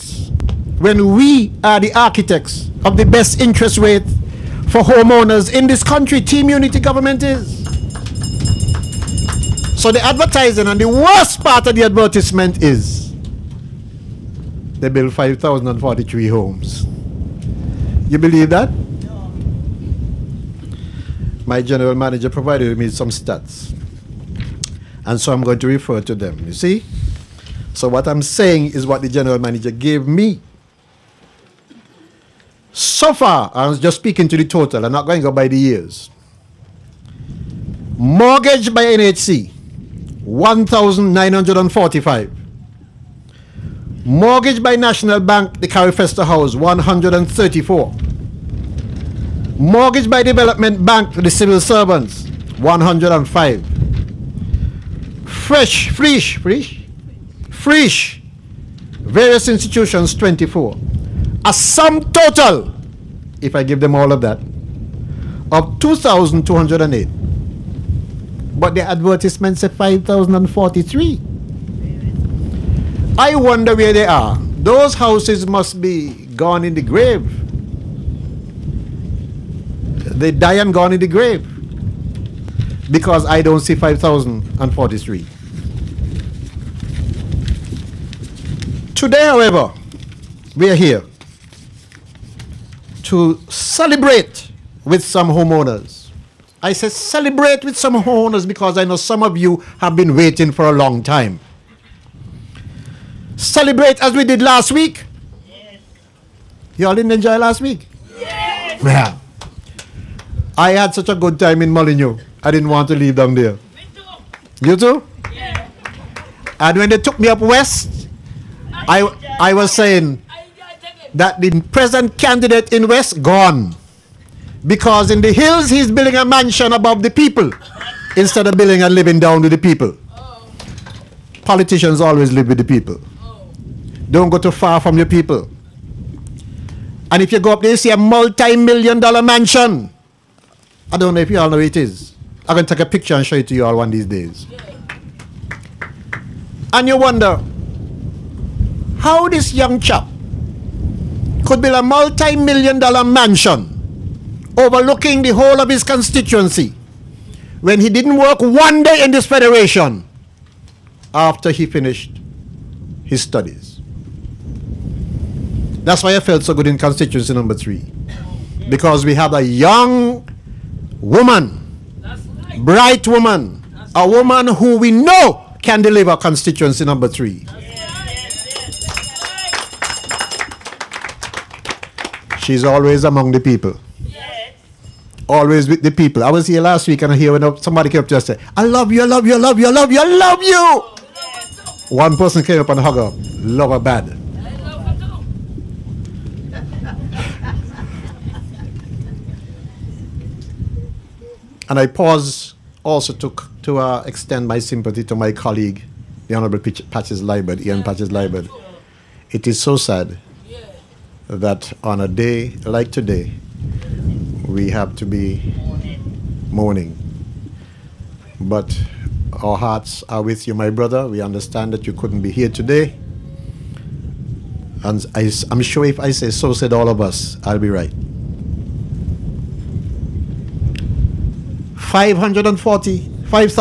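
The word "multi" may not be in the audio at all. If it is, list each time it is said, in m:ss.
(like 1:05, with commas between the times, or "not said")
2:17, 2:31.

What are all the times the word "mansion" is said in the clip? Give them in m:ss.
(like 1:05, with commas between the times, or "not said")
2:06, 2:19, 2:33.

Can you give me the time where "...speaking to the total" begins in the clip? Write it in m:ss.
0:33.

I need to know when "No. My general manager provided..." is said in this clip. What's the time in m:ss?
0:18.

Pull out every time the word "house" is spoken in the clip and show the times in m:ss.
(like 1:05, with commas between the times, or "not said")
0:45, 1:14.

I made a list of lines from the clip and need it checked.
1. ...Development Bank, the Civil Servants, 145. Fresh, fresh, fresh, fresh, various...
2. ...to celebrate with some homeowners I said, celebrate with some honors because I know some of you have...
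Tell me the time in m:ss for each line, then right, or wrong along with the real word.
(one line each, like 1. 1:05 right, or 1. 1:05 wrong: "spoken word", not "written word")
1. 0:50 wrong: "105", not "145"
2. 1:33 right.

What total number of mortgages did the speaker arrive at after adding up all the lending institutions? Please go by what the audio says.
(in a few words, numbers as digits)
2,208.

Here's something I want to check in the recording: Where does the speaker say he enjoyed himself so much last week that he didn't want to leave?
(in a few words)
Molyneux.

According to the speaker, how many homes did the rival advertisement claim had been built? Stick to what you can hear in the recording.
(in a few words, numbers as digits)
5,043.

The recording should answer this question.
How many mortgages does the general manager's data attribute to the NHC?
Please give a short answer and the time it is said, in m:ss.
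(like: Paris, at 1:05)
1,945, at 0:40.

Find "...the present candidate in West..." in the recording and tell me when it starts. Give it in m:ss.
2:01.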